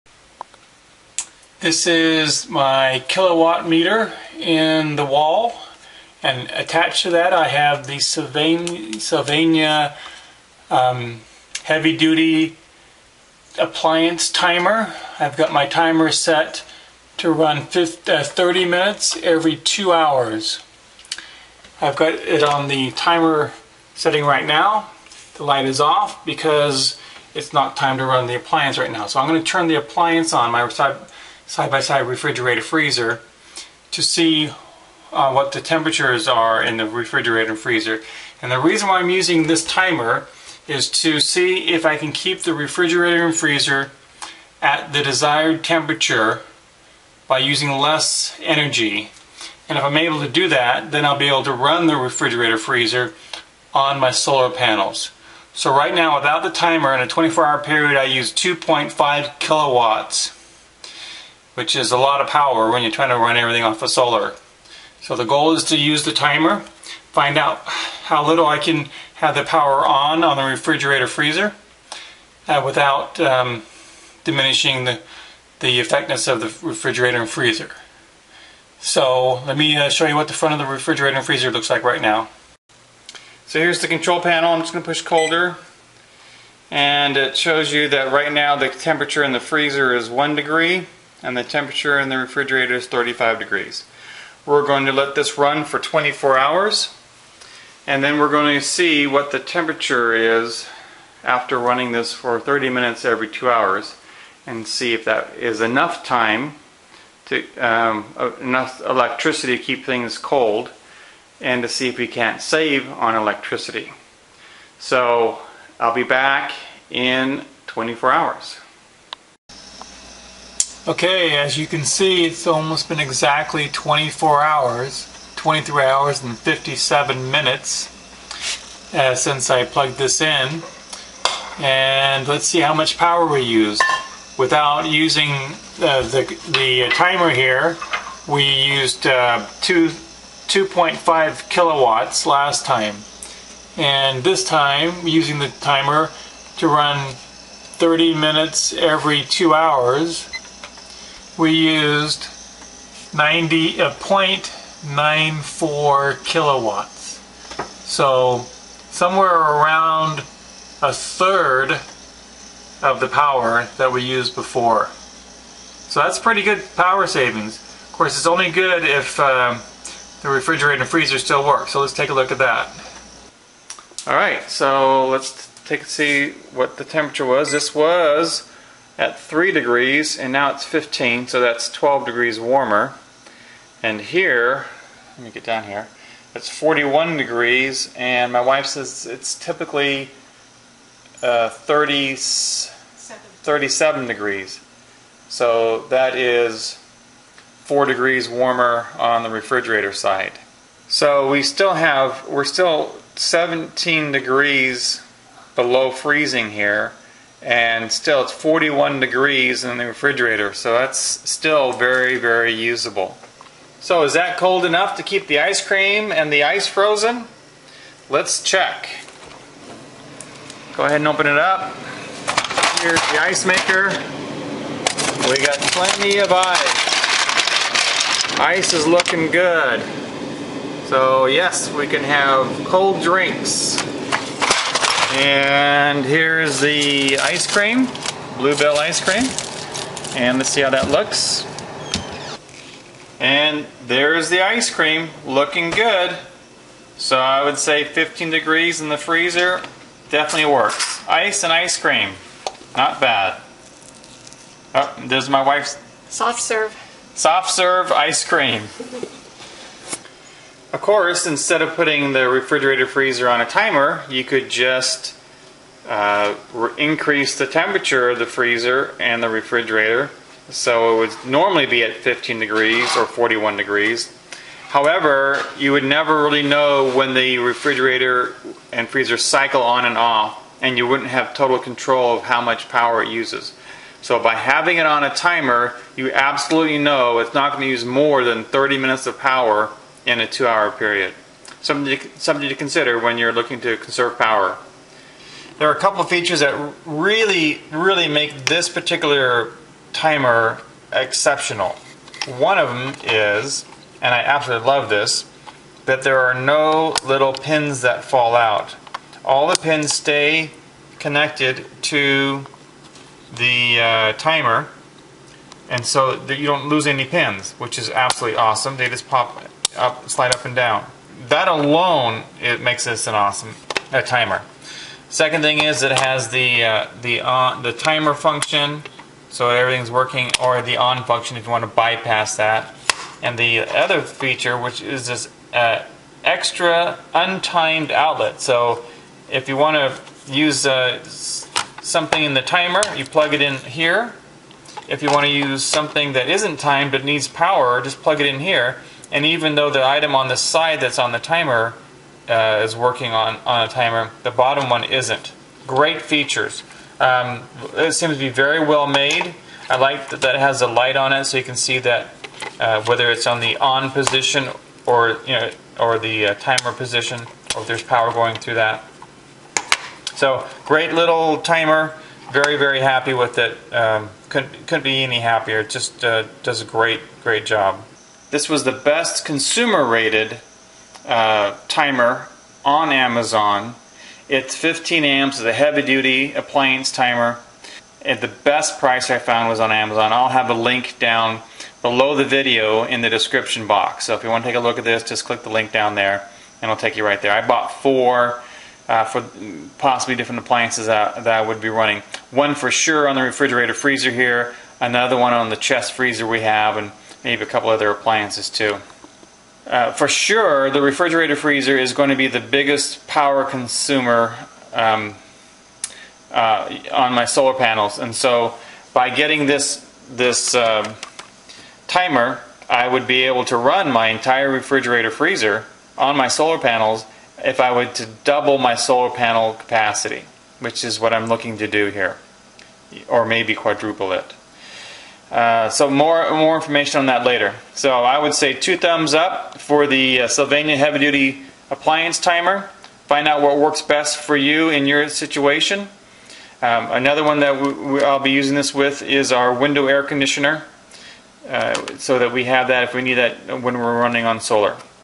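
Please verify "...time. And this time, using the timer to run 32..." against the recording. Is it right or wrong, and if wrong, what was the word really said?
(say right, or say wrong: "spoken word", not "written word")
wrong: "30", not "32".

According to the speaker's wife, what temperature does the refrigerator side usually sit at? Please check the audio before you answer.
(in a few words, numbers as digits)
37 degrees.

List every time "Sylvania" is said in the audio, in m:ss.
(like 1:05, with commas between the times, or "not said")
0:07, 7:20.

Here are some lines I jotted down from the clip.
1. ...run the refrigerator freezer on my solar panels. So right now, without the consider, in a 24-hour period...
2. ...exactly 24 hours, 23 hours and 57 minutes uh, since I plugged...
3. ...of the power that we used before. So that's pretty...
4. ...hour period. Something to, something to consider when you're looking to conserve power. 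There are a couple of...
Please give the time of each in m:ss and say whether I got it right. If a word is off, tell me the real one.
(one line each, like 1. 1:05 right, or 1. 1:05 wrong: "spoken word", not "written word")
1. 0:51 wrong: "timer", not "consider"
2. 2:02 right
3. 2:42 right
4. 4:50 right.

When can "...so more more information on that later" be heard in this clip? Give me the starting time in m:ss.
7:15.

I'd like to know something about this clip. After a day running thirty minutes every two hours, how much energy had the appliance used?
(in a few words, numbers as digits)
0.94 kilowatts.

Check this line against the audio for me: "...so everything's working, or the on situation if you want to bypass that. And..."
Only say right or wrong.
wrong.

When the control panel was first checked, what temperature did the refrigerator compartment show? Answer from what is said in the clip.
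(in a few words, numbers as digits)
35 degrees.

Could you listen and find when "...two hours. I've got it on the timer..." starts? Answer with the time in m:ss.
0:19.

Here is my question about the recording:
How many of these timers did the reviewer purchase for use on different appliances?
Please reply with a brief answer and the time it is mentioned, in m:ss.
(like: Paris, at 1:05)
4, at 6:37.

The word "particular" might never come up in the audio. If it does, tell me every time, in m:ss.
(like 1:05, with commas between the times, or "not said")
4:58.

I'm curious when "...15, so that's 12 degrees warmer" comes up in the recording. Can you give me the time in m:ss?
3:00.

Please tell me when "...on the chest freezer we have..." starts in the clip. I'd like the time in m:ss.
6:45.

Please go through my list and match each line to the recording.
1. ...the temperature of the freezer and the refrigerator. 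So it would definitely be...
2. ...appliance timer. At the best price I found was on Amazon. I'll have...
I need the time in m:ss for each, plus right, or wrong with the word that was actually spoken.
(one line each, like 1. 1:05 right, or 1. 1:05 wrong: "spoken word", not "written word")
1. 4:27 wrong: "normally", not "definitely"
2. 6:26 right.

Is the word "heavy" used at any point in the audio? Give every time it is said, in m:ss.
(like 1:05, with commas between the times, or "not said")
0:11, 6:25, 7:20.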